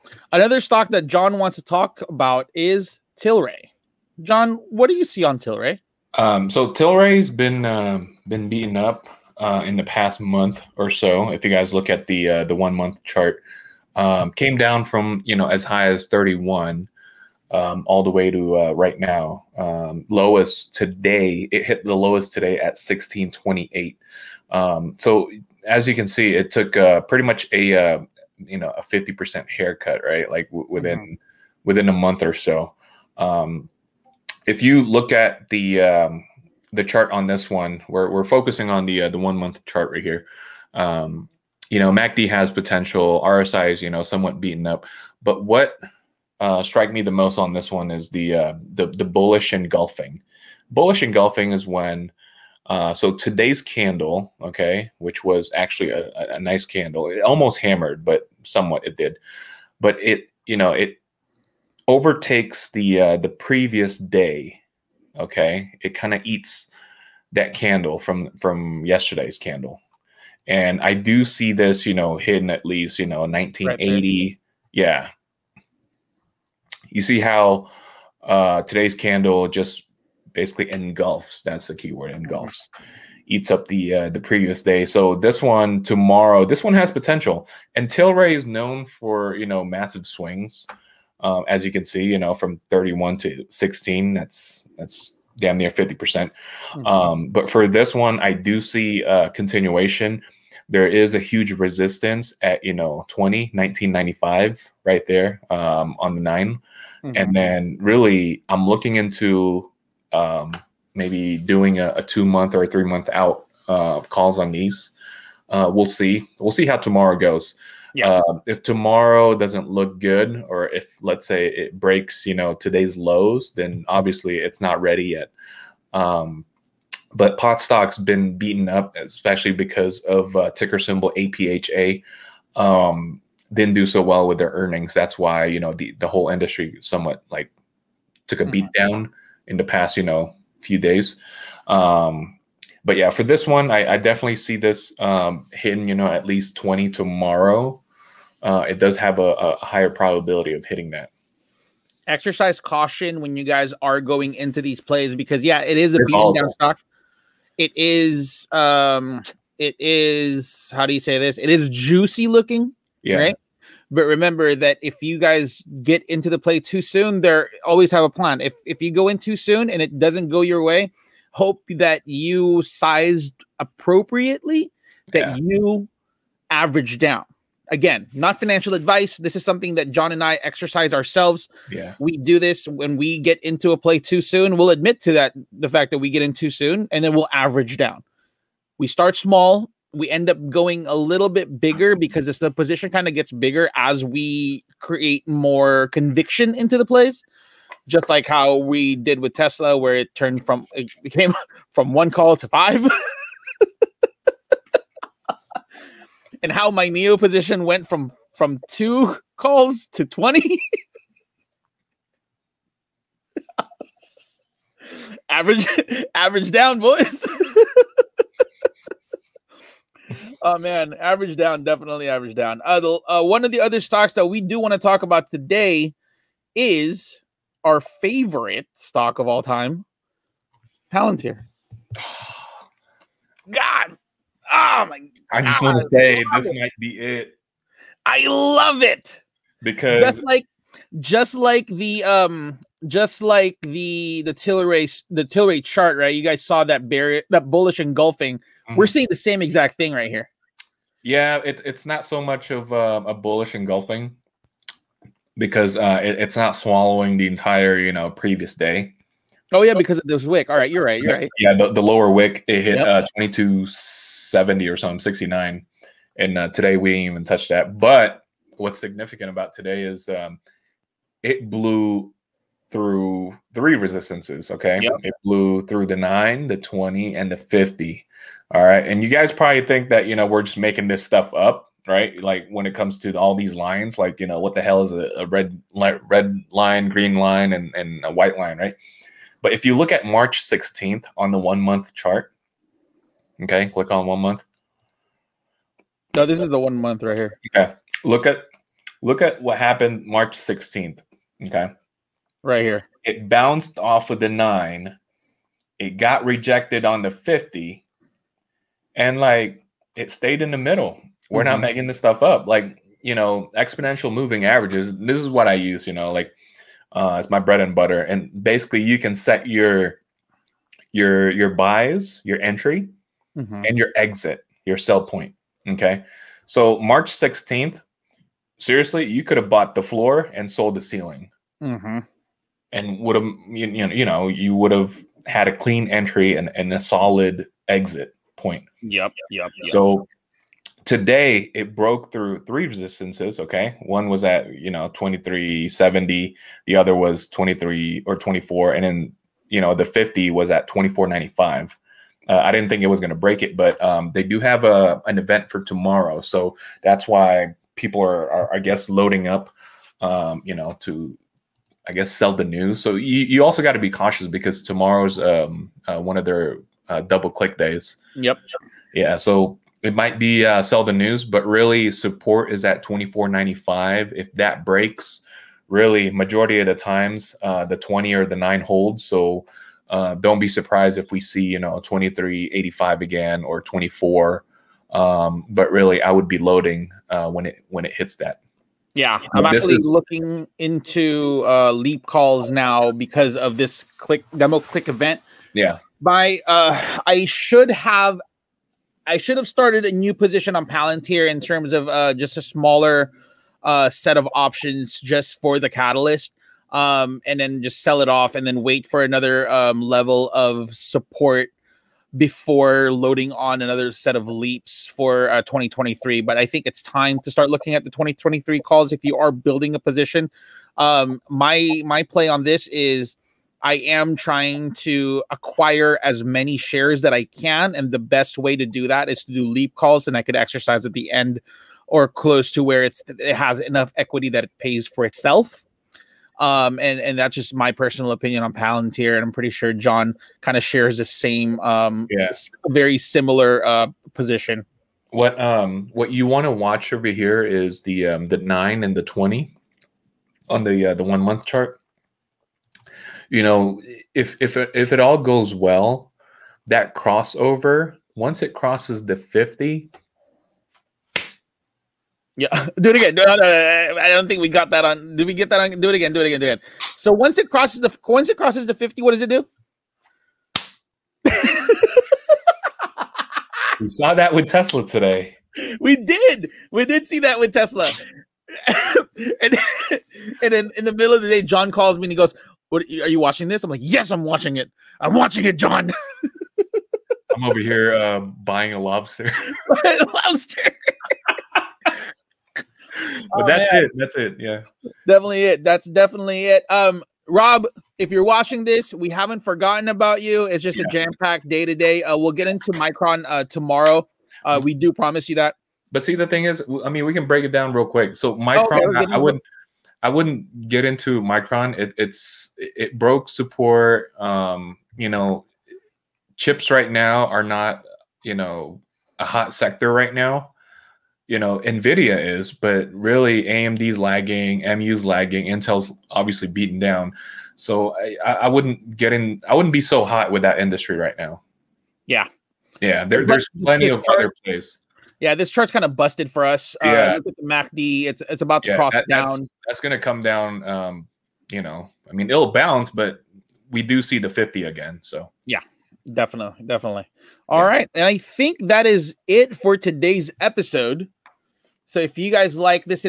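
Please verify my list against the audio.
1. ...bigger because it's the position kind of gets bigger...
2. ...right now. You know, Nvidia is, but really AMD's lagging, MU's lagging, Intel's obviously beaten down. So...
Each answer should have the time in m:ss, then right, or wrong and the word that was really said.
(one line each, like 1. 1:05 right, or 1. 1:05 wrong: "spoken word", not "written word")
1. 3:11 right
2. 8:39 right.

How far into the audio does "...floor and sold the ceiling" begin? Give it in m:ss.
5:29.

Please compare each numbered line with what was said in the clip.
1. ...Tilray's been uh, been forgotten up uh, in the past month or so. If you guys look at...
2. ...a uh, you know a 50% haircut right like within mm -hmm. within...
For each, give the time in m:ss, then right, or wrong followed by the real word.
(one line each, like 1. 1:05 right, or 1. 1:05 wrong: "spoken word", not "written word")
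1. 0:06 wrong: "beaten", not "forgotten"
2. 0:27 right.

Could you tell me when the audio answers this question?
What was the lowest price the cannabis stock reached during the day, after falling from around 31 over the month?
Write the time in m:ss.
0:22.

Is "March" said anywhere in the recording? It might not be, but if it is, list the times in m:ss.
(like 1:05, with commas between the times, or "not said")
4:50, 5:00, 5:26.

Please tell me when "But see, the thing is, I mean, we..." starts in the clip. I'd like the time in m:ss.
8:25.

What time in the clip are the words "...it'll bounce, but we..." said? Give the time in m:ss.
9:02.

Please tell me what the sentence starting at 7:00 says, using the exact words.
Um, my my play on this is I am trying to acquire as many shares that I can.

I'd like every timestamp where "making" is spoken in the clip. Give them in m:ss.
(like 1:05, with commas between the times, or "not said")
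4:40, 5:11.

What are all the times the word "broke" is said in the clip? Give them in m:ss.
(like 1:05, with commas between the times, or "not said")
5:41, 8:32.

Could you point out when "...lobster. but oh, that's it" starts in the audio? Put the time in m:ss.
8:10.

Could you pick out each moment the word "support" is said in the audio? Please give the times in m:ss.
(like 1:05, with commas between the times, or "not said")
6:11, 6:50, 8:33.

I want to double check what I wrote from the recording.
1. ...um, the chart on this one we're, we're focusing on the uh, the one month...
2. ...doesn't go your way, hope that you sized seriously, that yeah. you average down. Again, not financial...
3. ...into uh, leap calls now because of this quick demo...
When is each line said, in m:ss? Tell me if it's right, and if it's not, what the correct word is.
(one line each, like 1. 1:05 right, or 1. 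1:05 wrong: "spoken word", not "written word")
1. 0:35 right
2. 2:49 wrong: "appropriately", not "seriously"
3. 6:30 wrong: "click", not "quick".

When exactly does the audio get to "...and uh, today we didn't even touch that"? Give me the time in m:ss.
4:26.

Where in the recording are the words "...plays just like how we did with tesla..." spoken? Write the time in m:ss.
3:16.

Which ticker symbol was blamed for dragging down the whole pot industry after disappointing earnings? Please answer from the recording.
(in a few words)
APHA.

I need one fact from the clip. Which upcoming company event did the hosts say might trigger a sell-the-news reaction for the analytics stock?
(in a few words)
double click days.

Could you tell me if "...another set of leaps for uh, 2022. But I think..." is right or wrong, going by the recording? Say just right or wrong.
wrong.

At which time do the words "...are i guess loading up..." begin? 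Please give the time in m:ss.
5:58.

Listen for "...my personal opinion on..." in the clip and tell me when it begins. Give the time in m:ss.
7:17.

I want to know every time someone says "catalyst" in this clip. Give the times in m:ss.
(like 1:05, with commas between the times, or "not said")
6:45.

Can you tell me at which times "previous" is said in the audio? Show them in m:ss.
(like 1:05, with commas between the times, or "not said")
1:03, 1:24, 4:18.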